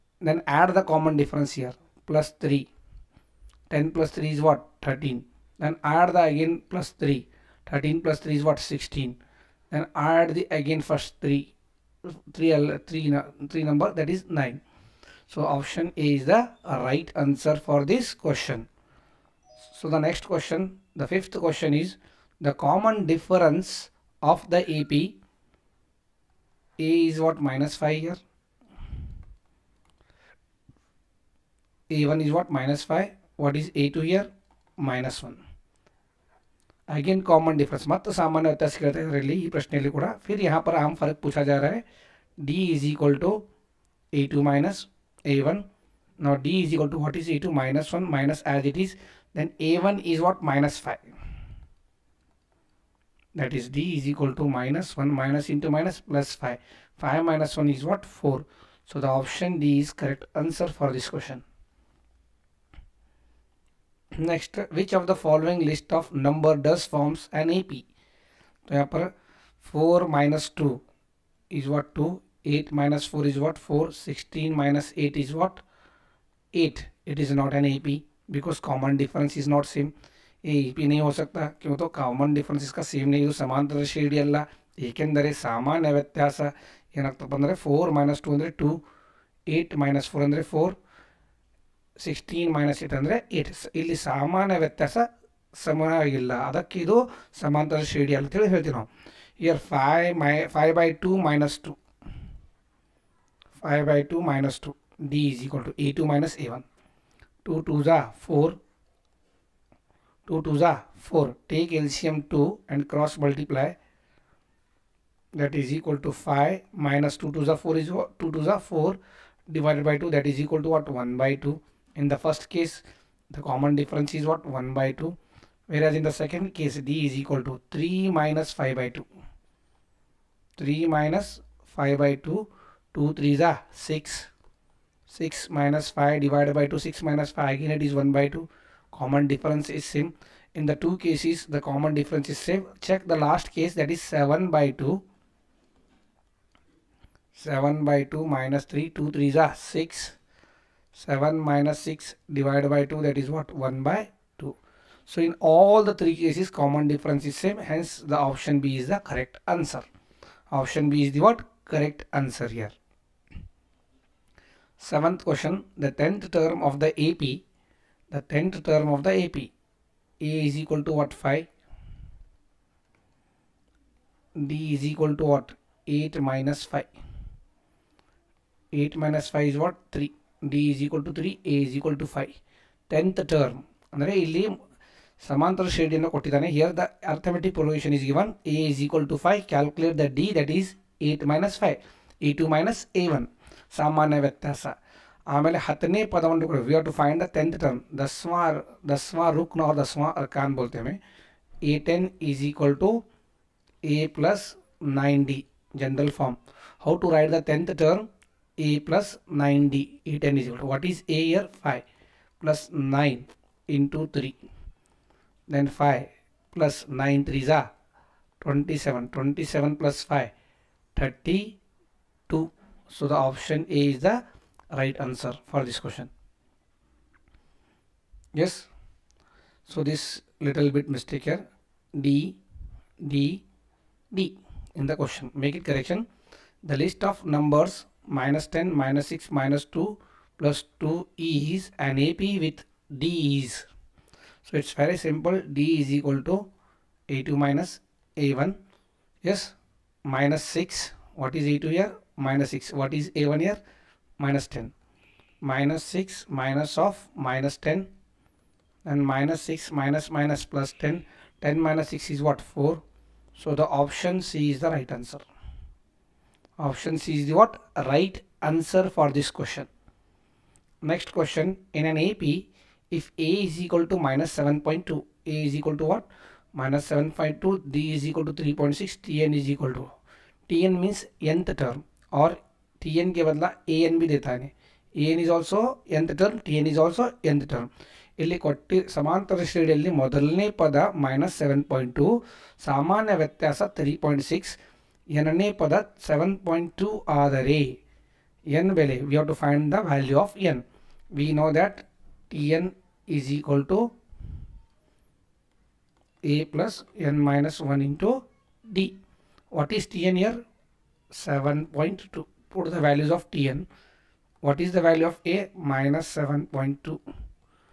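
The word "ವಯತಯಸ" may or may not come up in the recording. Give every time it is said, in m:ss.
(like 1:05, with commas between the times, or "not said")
1:25, 1:34, 4:53.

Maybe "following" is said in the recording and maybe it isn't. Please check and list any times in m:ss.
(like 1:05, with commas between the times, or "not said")
1:05.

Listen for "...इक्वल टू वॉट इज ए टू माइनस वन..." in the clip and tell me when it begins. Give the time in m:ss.
0:46.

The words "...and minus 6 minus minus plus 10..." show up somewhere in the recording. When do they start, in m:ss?
4:18.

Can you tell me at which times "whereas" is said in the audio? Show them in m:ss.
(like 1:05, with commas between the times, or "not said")
2:05.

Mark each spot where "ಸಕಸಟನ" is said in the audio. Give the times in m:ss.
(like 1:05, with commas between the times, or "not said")
0:08, 1:32.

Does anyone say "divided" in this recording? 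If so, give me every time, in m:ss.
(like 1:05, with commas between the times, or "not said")
1:59, 2:16, 2:32.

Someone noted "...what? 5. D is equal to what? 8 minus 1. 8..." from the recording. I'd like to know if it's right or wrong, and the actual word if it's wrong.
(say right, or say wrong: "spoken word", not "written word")
wrong: "5", not "1".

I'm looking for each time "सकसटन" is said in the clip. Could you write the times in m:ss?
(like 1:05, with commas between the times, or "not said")
1:13.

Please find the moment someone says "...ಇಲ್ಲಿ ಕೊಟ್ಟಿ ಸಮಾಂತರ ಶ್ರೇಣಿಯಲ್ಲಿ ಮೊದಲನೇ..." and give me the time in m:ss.
4:48.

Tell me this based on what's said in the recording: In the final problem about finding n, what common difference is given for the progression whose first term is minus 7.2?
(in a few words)
3.6.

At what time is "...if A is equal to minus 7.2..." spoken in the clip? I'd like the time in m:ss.
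4:32.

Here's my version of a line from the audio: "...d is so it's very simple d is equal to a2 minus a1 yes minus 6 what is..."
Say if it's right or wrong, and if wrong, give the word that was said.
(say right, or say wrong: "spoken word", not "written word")
right.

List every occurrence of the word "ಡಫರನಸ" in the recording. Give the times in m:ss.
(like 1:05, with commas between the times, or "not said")
0:01, 1:22.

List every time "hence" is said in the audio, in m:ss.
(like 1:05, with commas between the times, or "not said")
2:37.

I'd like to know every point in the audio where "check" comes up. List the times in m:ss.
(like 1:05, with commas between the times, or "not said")
2:22.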